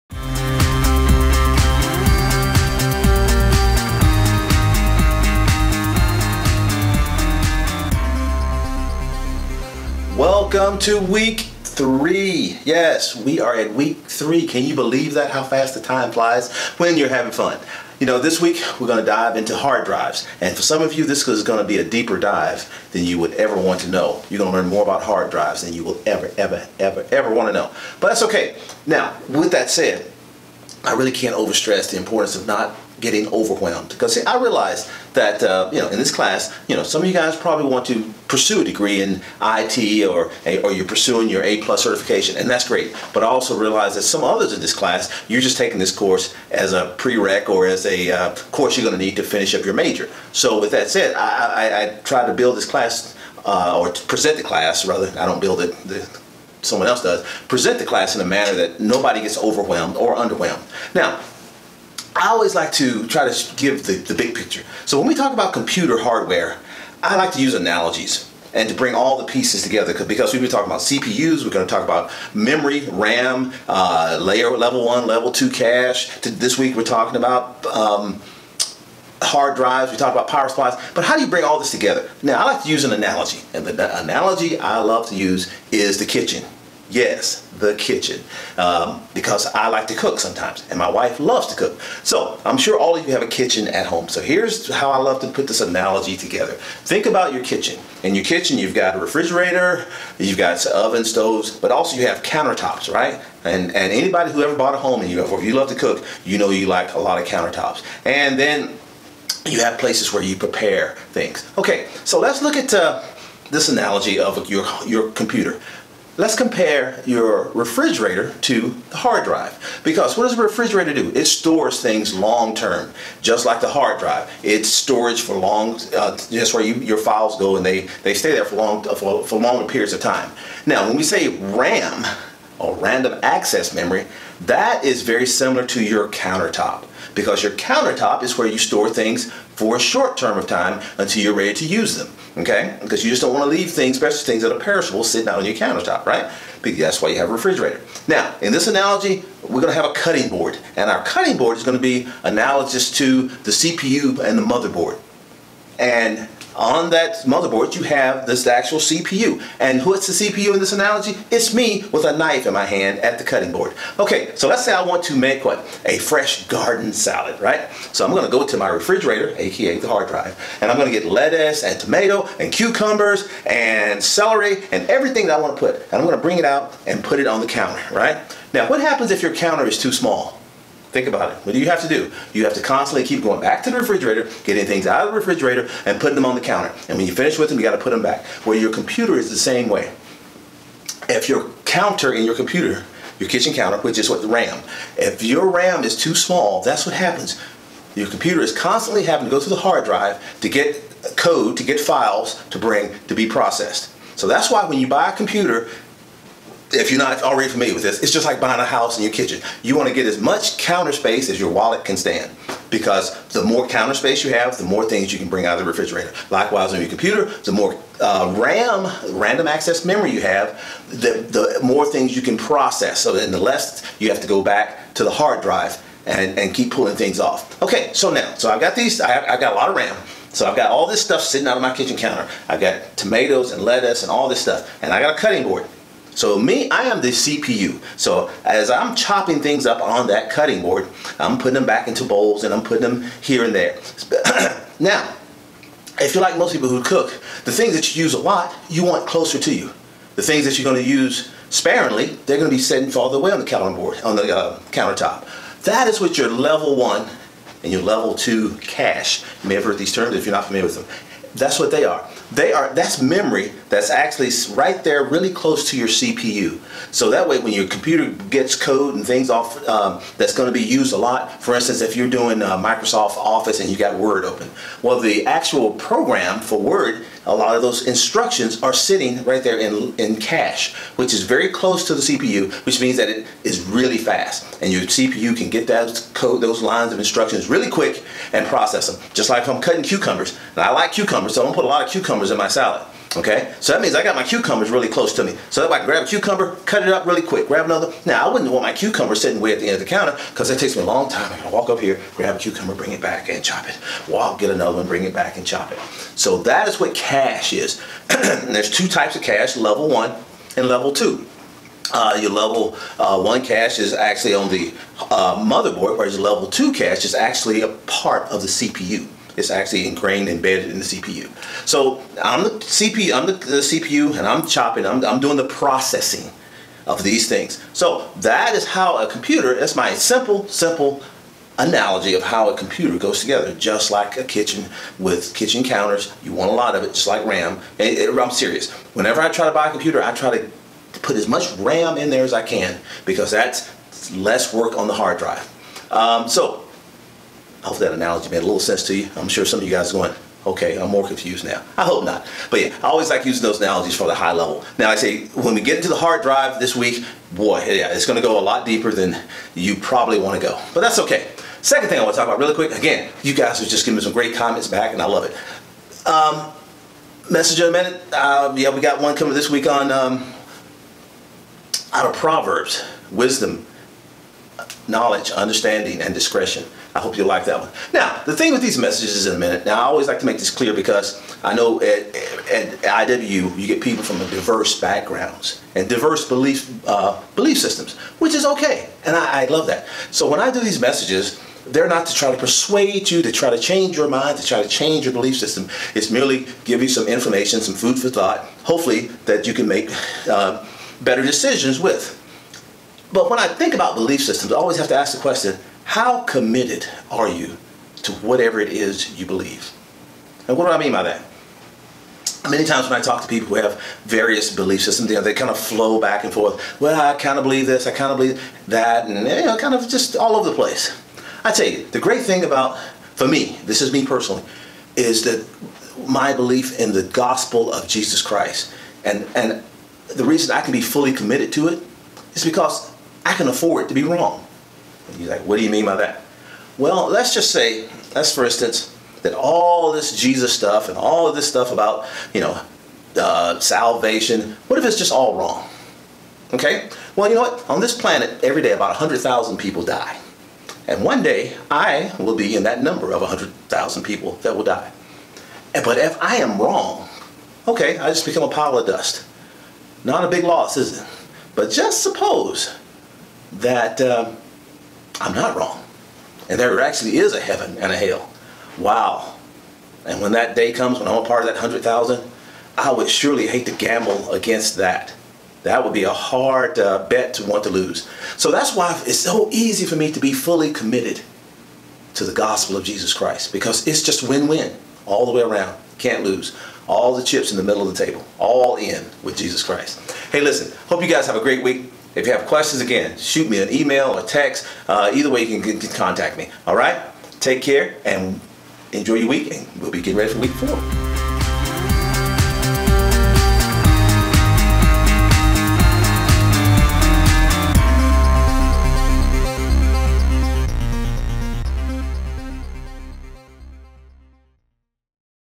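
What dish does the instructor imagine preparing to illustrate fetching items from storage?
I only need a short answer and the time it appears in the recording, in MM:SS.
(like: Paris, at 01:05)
Fresh garden salad, at 02:45.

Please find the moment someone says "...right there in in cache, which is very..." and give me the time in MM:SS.
04:39.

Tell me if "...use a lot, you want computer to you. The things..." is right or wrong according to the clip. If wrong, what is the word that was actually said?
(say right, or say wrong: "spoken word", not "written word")
wrong: "closer", not "computer".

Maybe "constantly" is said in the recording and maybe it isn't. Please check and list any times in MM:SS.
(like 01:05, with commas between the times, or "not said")
03:02, 03:18.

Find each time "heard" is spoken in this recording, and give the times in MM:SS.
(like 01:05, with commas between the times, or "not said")
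04:19.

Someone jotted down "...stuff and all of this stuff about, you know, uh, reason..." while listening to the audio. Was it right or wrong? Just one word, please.
wrong.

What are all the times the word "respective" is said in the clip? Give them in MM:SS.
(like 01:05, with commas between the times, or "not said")
not said.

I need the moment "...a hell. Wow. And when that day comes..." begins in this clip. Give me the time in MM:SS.
07:47.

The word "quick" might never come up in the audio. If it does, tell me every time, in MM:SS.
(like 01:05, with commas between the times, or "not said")
04:47, 04:57, 06:02.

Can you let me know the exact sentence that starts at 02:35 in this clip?
And on that motherboard, you have this actual CPU.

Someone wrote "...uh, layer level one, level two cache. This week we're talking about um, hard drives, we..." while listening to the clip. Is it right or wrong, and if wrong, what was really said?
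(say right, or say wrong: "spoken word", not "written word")
right.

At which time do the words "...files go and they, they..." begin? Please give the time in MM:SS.
02:06.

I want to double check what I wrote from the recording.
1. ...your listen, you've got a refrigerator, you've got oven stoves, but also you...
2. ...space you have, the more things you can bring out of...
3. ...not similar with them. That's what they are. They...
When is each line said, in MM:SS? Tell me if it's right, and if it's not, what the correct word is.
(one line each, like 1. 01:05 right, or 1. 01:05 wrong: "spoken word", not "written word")
1. 01:38 wrong: "kitchen", not "listen"
2. 03:33 right
3. 04:20 wrong: "familiar", not "similar".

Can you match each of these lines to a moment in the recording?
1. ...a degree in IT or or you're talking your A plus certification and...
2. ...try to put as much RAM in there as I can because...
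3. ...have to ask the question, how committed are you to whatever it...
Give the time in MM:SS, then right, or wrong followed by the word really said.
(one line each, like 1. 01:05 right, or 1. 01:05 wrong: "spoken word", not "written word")
1. 00:38 wrong: "pursuing", not "talking"
2. 05:40 right
3. 06:44 right.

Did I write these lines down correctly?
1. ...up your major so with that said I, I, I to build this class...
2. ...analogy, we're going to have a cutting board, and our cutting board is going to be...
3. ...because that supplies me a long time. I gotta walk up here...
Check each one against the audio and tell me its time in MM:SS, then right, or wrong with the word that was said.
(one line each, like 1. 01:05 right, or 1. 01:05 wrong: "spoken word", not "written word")
1. 00:49 right
2. 02:28 right
3. 05:00 wrong: "takes", not "supplies".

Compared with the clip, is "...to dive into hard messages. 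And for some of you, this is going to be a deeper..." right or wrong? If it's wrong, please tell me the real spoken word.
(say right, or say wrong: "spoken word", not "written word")
wrong: "drives", not "messages".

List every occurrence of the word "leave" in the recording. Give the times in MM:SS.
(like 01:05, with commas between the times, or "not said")
02:23.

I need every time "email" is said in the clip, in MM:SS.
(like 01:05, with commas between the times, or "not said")
08:13.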